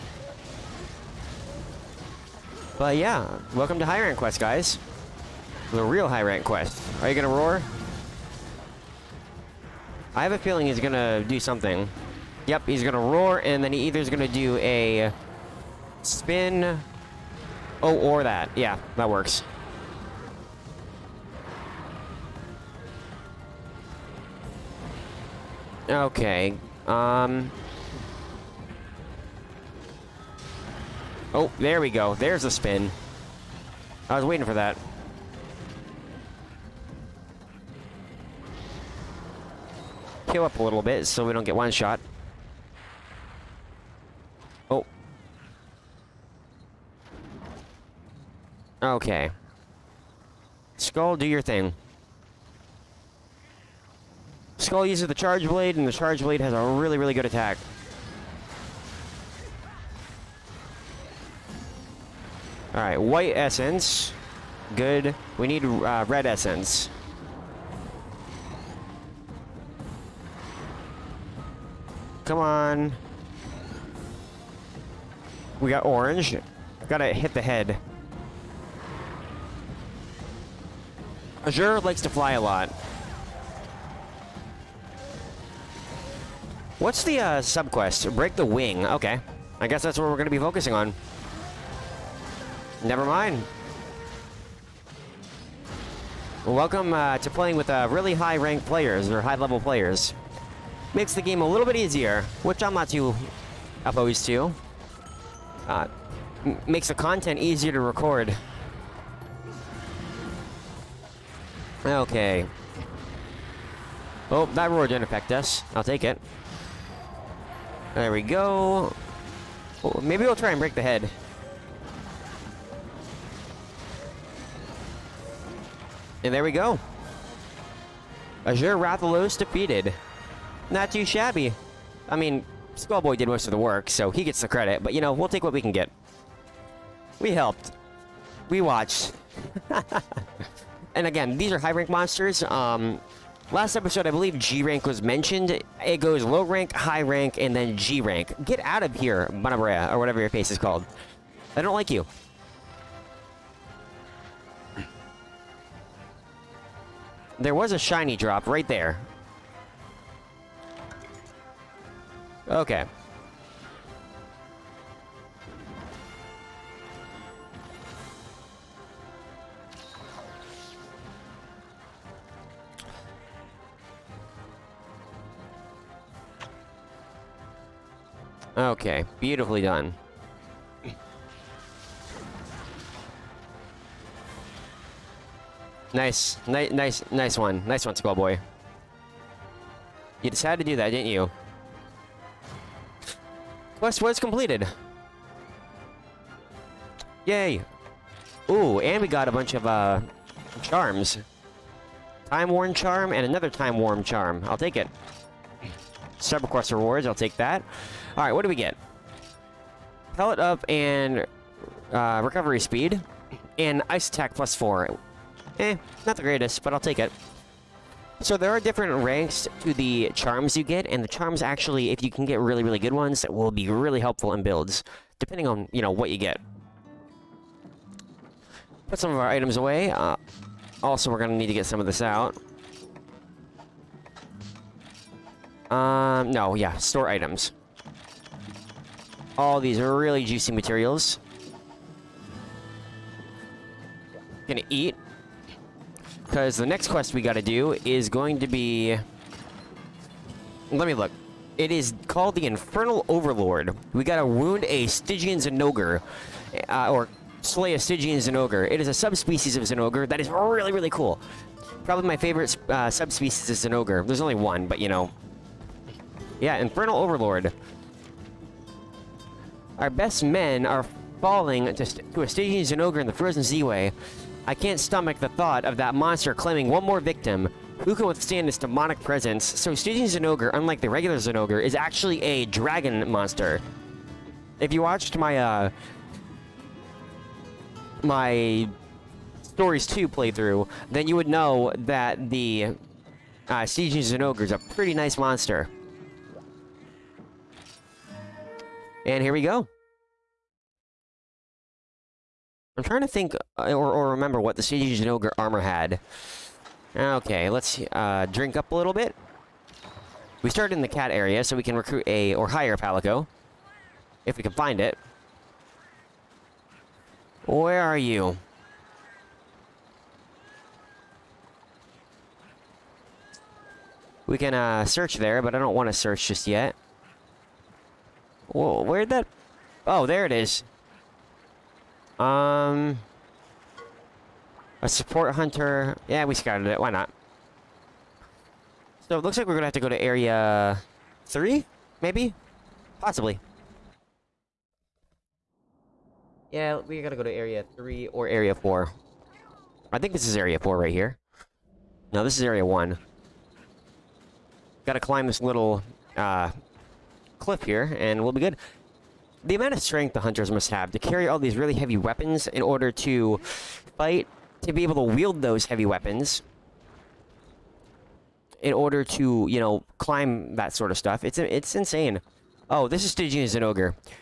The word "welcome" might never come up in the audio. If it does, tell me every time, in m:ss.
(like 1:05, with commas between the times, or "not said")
0:03, 1:36.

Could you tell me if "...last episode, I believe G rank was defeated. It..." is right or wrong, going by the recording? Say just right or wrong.
wrong.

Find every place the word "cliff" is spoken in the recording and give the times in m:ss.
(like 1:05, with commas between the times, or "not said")
5:57.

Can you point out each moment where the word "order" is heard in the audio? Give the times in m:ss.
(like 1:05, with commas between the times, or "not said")
6:02, 6:08.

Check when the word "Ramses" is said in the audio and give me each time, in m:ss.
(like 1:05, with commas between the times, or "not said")
not said.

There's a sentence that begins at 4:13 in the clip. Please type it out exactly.
We gotta wound a Stygian Zenogre, uh, or slay a Stygian Zenogre.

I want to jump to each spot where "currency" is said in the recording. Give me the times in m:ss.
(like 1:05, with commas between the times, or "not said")
not said.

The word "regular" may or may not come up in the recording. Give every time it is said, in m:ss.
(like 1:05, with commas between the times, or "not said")
4:40.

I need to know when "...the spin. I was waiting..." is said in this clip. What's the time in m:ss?
0:32.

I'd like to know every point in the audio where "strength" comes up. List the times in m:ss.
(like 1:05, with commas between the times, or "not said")
5:59.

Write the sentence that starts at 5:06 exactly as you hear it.
Okay, let's uh, drink up a little bit.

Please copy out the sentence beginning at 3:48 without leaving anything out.
Put some of our items away.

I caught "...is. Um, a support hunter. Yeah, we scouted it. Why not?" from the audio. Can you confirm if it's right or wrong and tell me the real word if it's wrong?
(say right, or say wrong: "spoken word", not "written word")
right.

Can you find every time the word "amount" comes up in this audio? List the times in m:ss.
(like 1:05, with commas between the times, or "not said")
5:59.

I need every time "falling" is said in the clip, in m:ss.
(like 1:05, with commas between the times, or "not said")
4:31.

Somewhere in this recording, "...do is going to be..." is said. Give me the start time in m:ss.
4:07.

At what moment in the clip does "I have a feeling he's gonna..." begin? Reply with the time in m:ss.
0:10.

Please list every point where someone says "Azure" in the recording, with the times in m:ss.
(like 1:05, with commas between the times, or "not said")
1:21, 2:08.